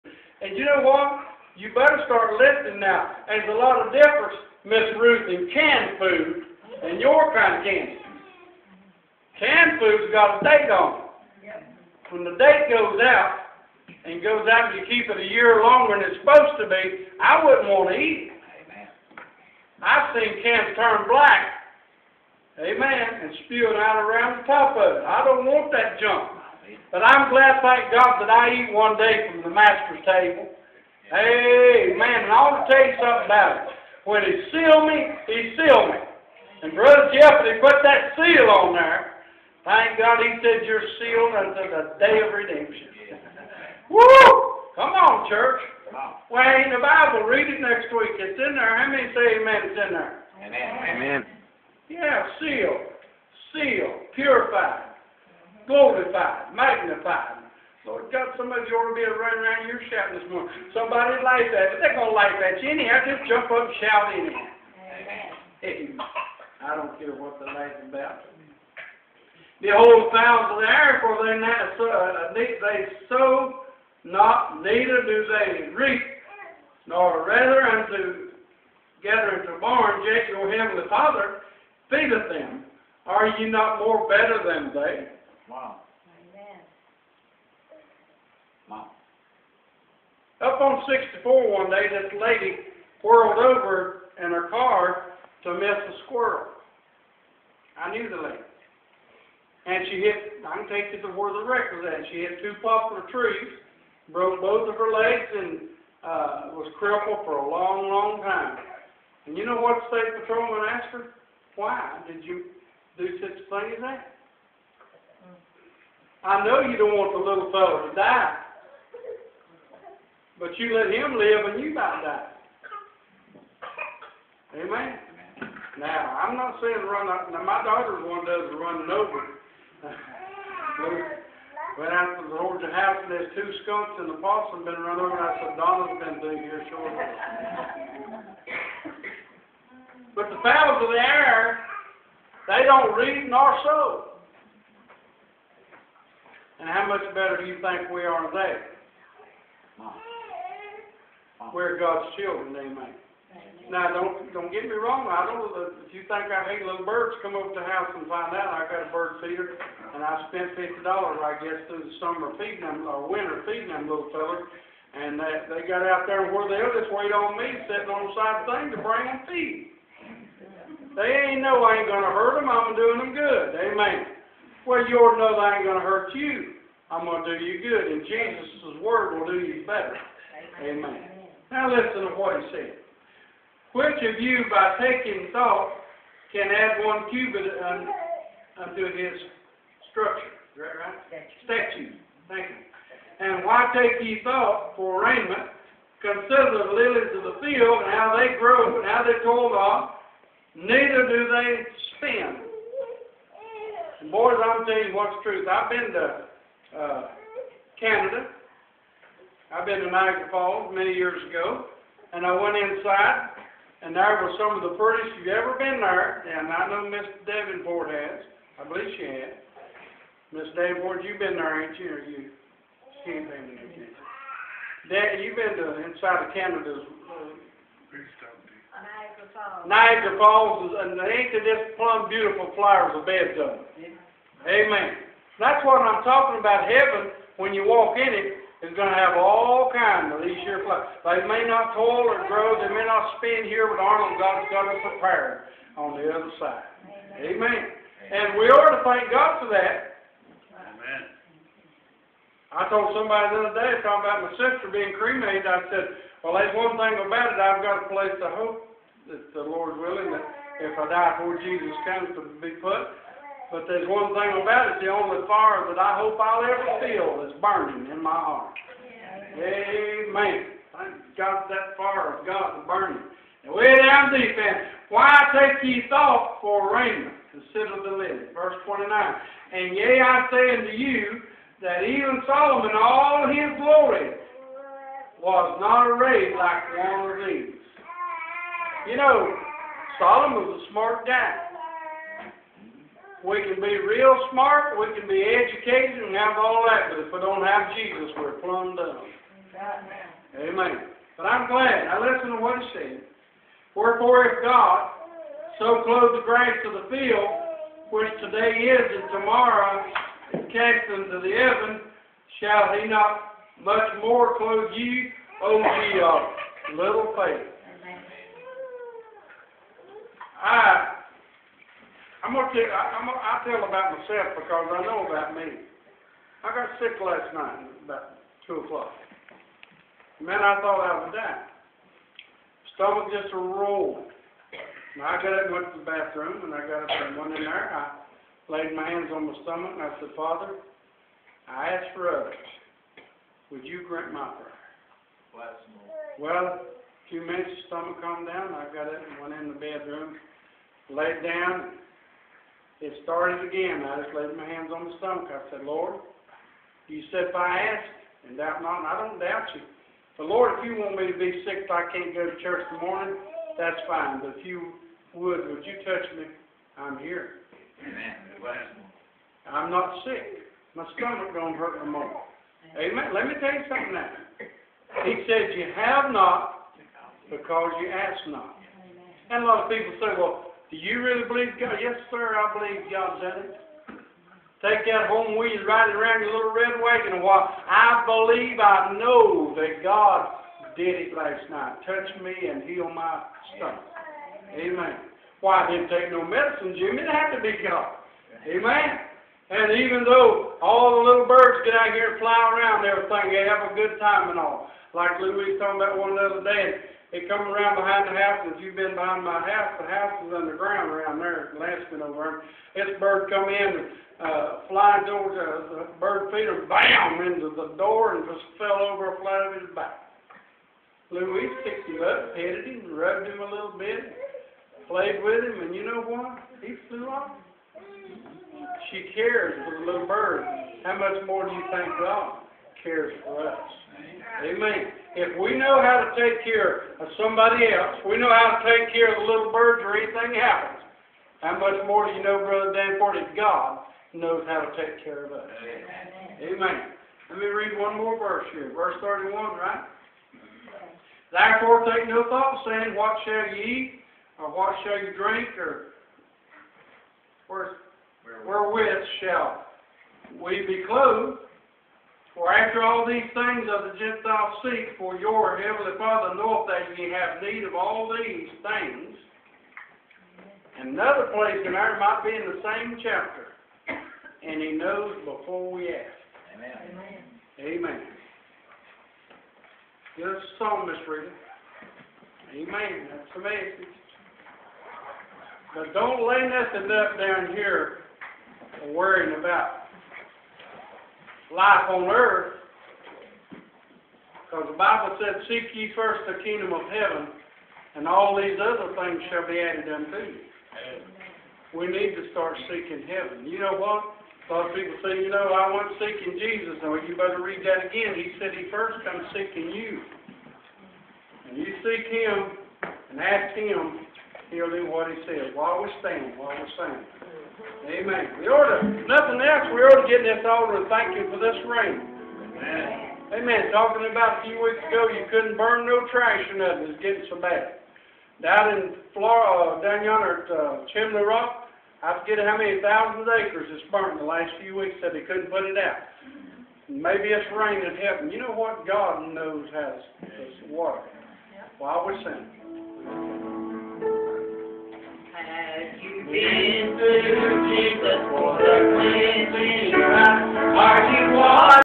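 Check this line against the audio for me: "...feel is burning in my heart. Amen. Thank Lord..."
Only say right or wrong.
wrong.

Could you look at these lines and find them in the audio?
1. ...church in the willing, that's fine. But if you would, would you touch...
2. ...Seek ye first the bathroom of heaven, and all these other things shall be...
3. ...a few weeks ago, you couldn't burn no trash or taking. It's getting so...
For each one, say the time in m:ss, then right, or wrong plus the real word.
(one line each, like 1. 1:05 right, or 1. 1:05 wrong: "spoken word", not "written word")
1. 6:02 wrong: "morning", not "willing"
2. 8:15 wrong: "kingdom", not "bathroom"
3. 8:44 wrong: "nothing", not "taking".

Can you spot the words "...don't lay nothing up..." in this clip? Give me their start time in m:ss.
8:05.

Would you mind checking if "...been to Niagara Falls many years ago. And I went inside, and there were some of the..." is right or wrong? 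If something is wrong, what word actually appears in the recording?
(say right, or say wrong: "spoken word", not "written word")
right.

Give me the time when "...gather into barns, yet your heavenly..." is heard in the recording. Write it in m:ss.
1:19.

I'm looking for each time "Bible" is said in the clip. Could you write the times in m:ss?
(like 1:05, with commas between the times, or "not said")
0:46, 8:14.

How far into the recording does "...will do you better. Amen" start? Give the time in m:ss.
2:59.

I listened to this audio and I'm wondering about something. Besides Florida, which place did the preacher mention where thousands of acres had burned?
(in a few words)
Chimney Rock.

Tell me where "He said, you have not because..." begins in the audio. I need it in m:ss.
6:15.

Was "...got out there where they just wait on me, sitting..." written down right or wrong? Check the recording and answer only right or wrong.
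right.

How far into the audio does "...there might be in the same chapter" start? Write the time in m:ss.
7:51.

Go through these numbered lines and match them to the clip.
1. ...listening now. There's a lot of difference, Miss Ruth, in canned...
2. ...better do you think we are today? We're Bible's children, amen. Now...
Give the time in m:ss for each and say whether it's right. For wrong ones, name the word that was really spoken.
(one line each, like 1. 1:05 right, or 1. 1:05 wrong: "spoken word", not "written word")
1. 0:02 right
2. 2:27 wrong: "God", not "Bible".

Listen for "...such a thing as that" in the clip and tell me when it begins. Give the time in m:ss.
1:53.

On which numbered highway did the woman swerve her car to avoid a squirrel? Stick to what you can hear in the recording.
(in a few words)
64.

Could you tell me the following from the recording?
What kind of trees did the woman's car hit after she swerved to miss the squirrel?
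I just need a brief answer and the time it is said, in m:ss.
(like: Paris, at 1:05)
Poplar trees, at 1:42.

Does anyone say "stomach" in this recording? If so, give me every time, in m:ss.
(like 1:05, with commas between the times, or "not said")
5:32, 5:39, 5:47, 5:54, 6:10, 6:33.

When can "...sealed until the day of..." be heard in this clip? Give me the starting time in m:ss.
0:40.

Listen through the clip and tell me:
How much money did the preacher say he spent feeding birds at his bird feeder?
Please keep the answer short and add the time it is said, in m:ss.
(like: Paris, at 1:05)
$50, at 2:40.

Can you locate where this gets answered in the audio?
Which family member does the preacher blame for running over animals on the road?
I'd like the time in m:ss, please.
2:15.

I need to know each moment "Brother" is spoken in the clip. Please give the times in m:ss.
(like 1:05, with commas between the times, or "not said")
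0:36, 7:22.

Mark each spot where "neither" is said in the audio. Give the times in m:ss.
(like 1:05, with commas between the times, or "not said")
1:14, 3:20.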